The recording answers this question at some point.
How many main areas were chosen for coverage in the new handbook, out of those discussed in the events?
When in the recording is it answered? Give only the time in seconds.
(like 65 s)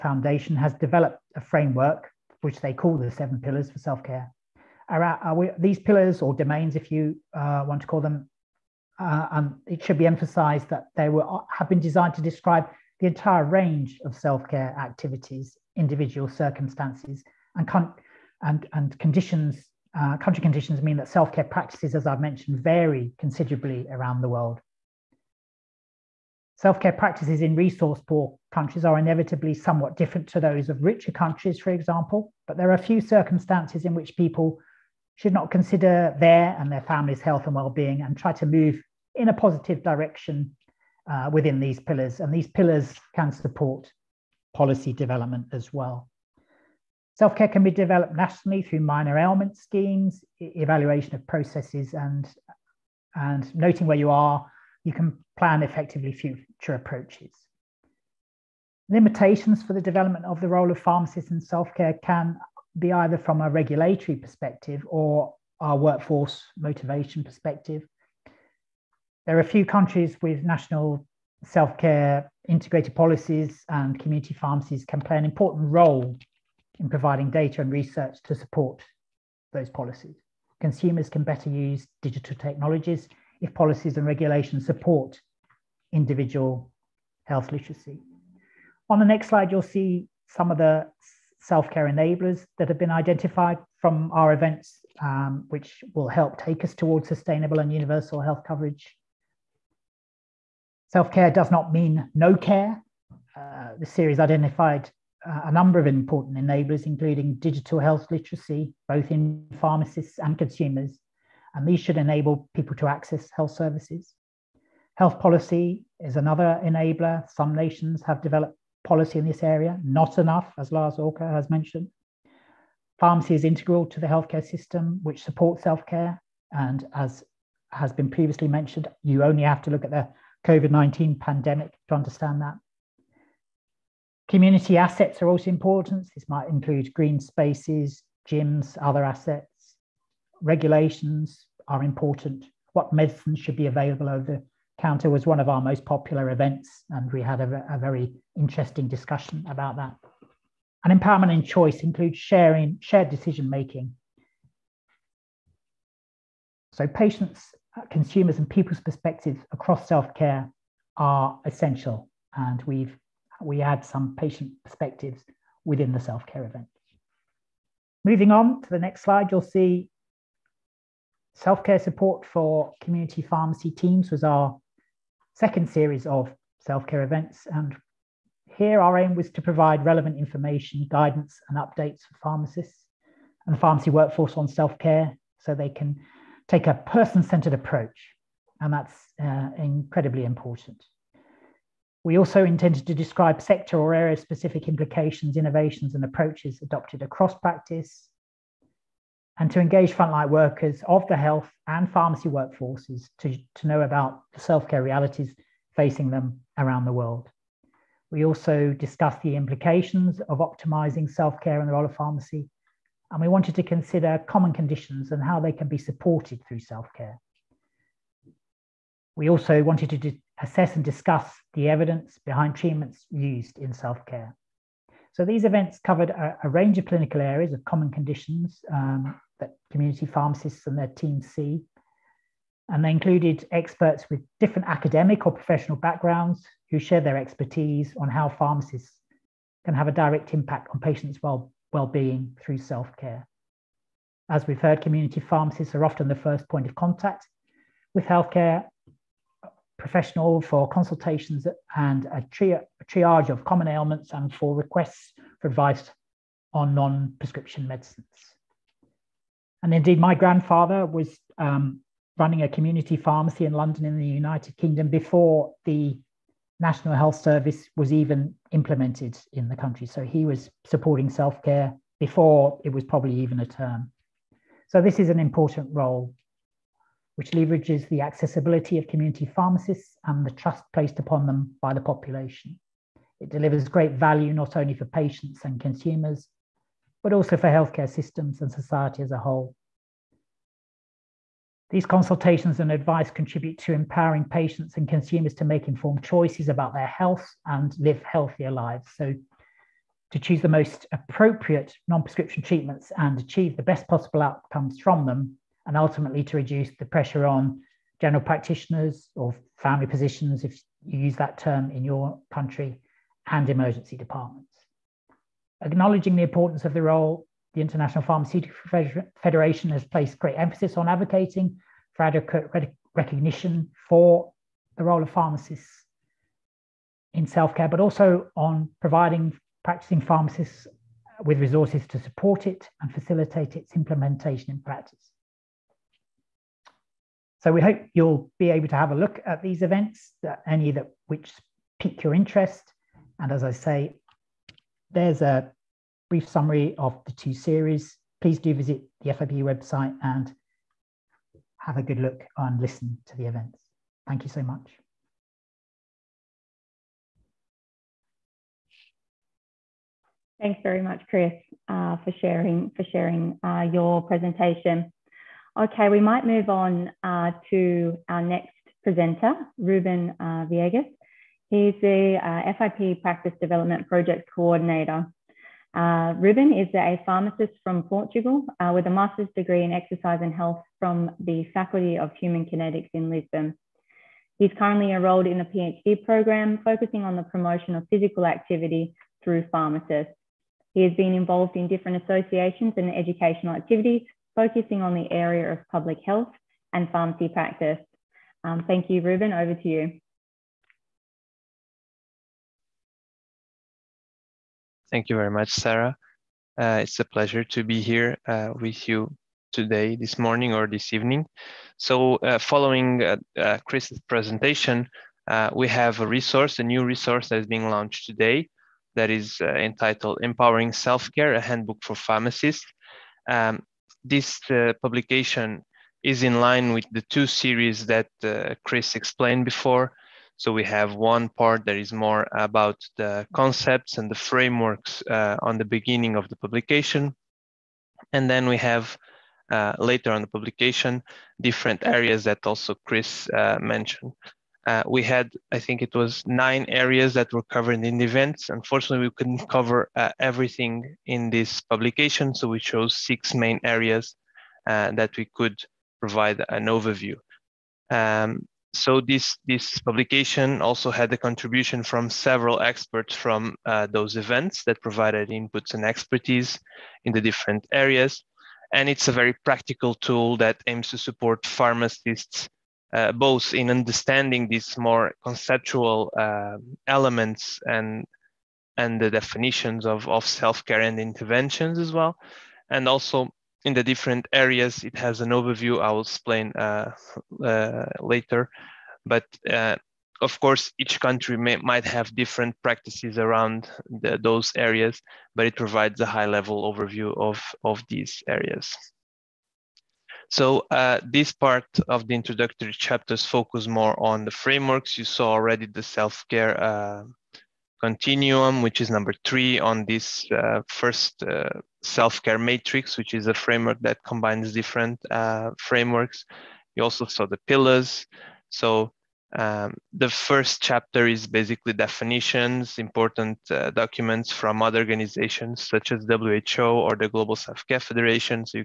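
452 s.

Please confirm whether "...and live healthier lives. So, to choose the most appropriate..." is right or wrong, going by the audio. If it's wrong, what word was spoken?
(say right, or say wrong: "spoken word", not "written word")
right.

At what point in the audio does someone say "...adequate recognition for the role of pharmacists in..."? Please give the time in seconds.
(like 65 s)
322 s.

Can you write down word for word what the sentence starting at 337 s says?
So we hope you'll be able to have a look at these events, that any that which pique your interest.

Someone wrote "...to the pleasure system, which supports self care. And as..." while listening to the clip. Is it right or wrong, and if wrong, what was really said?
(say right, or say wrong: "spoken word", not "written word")
wrong: "healthcare", not "pleasure".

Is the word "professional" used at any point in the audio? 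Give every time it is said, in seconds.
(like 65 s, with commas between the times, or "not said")
235 s, 249 s.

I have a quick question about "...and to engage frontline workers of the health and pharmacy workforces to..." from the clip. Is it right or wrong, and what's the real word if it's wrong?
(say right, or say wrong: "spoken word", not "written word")
right.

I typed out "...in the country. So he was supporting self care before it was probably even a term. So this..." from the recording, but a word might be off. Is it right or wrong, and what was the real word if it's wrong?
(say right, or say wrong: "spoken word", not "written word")
right.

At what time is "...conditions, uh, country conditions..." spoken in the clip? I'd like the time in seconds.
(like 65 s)
18 s.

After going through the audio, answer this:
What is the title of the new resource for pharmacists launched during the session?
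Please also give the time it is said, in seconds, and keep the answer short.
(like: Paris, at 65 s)
Empowering Self-Care, a Handbook for Pharmacists, at 420 s.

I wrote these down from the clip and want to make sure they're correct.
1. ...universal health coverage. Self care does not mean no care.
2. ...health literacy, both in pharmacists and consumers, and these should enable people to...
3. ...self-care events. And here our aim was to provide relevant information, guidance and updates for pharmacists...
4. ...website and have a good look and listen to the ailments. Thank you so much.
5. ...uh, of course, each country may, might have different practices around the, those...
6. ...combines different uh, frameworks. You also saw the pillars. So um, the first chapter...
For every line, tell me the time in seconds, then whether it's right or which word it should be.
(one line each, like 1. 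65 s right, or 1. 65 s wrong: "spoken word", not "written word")
1. 97 s right
2. 107 s right
3. 176 s right
4. 349 s wrong: "events", not "ailments"
5. 489 s right
6. 514 s right.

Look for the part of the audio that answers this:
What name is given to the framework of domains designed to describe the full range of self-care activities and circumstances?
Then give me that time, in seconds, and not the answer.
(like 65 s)
3 s.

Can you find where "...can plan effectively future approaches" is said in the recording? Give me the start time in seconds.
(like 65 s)
54 s.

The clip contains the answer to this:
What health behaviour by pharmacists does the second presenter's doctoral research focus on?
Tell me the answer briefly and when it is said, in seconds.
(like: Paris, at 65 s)
physical activity, at 387 s.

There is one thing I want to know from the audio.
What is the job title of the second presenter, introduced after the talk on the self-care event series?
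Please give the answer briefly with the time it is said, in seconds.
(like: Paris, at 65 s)
FIP Practice Development Project Coordinator, at 372 s.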